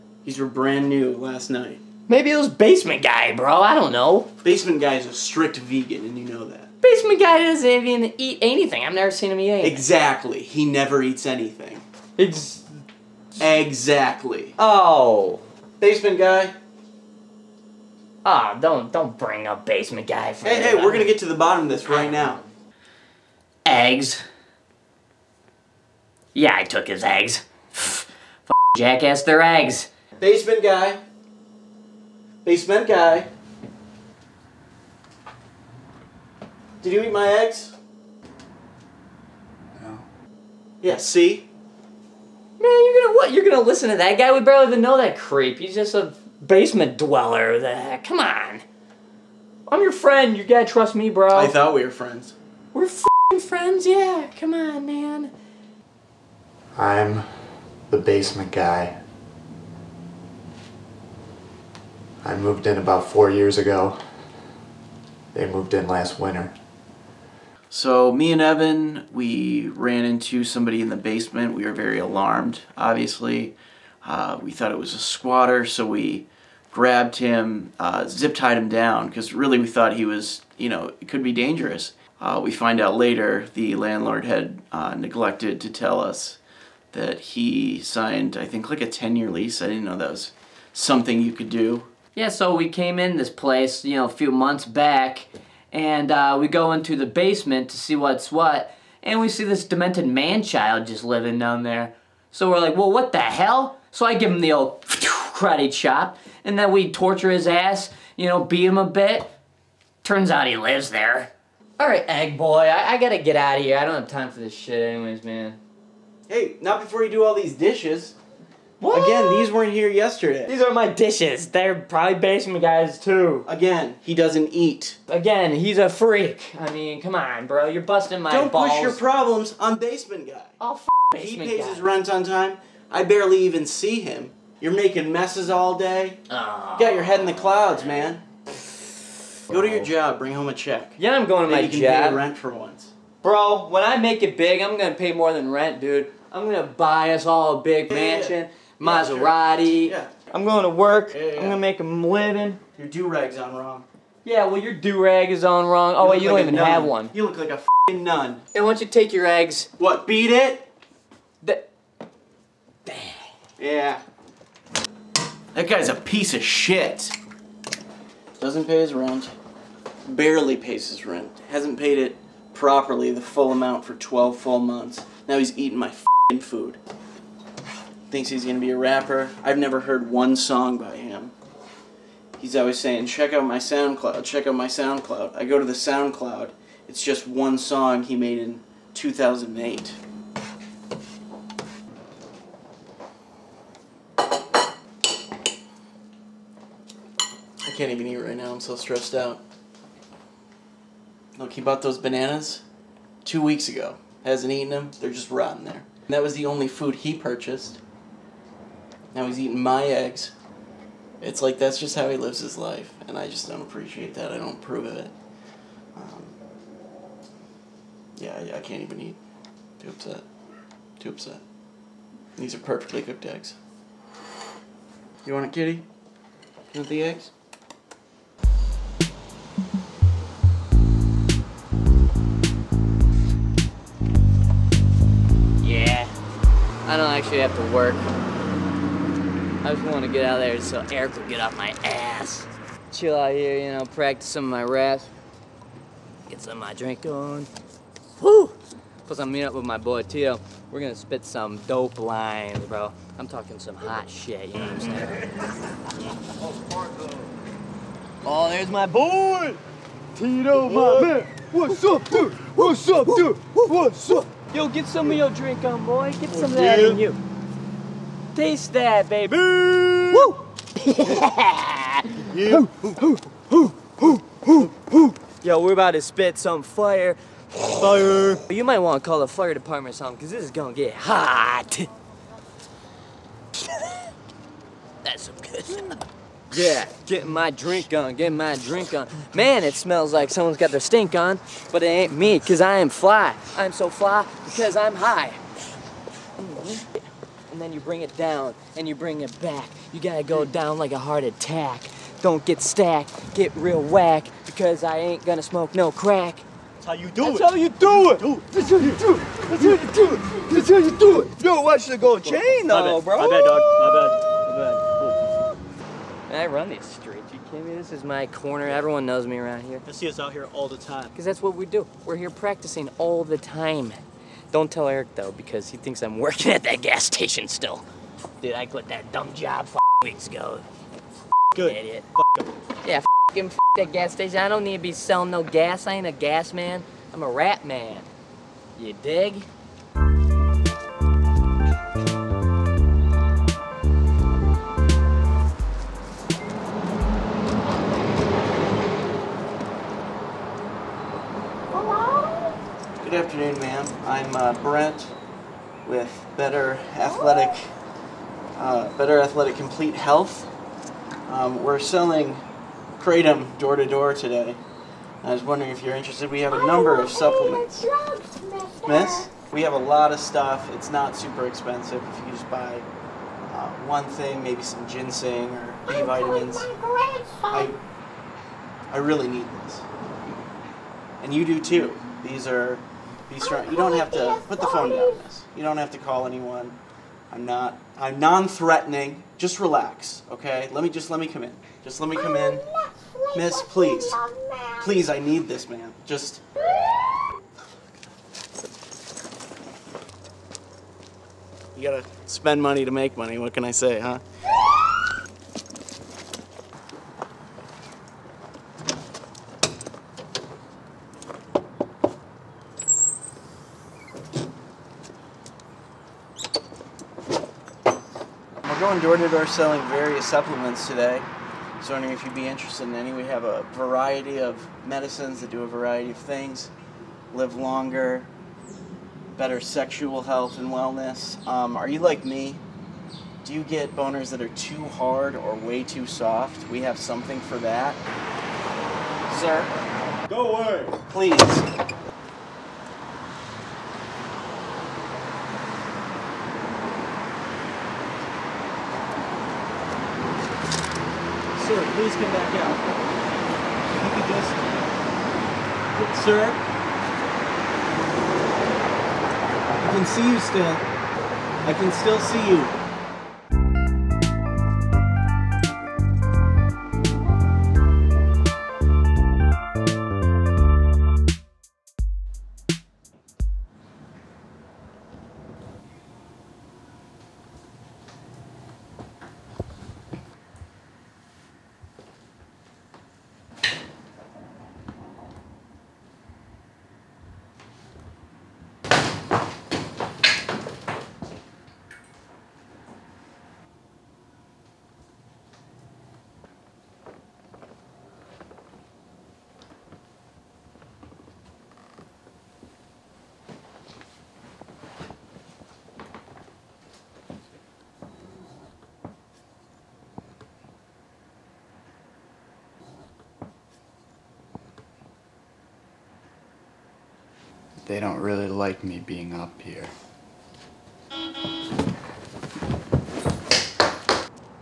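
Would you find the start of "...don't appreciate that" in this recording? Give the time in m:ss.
3:33.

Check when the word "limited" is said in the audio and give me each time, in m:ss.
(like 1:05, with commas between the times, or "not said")
not said.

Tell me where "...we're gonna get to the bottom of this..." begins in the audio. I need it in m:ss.
0:20.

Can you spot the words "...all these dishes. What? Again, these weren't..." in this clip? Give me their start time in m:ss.
1:57.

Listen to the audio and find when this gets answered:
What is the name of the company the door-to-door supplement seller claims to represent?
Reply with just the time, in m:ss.
5:58.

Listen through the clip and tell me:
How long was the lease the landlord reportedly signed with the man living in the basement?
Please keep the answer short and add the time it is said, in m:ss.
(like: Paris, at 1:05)
10 years, at 1:28.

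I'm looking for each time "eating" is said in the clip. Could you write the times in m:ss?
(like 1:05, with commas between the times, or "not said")
2:55, 3:29.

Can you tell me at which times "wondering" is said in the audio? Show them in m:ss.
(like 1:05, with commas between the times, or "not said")
6:05, 7:01.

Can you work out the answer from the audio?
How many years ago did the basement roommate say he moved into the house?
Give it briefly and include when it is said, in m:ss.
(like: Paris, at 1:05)
4, at 1:03.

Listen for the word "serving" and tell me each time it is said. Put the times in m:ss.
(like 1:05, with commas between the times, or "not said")
not said.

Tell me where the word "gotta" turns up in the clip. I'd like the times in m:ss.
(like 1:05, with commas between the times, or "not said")
0:50, 1:52, 4:59, 6:41.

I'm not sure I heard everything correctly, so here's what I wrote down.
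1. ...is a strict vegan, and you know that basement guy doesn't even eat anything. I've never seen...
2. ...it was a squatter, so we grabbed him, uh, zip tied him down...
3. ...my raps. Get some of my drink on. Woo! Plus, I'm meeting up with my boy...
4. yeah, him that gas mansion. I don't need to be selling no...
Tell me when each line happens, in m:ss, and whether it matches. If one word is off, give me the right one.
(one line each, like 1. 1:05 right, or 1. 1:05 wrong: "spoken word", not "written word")
1. 0:04 right
2. 1:14 right
3. 4:04 right
4. 5:32 wrong: "station", not "mansion".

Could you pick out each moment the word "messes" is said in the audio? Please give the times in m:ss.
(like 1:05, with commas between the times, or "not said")
2:15.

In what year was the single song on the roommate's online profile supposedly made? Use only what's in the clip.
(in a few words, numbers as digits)
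2008.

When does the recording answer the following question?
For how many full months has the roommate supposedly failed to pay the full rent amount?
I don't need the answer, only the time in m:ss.
2:53.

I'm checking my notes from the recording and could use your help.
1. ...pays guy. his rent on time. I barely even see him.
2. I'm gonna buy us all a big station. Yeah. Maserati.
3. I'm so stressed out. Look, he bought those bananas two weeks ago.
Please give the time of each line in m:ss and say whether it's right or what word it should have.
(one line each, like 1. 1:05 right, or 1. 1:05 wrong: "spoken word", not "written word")
1. 2:11 right
2. 2:26 wrong: "mansion", not "station"
3. 3:18 right.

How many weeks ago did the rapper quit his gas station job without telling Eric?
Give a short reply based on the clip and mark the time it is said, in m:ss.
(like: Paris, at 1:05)
5, at 5:29.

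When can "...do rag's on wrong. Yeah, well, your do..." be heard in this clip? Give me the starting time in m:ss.
2:32.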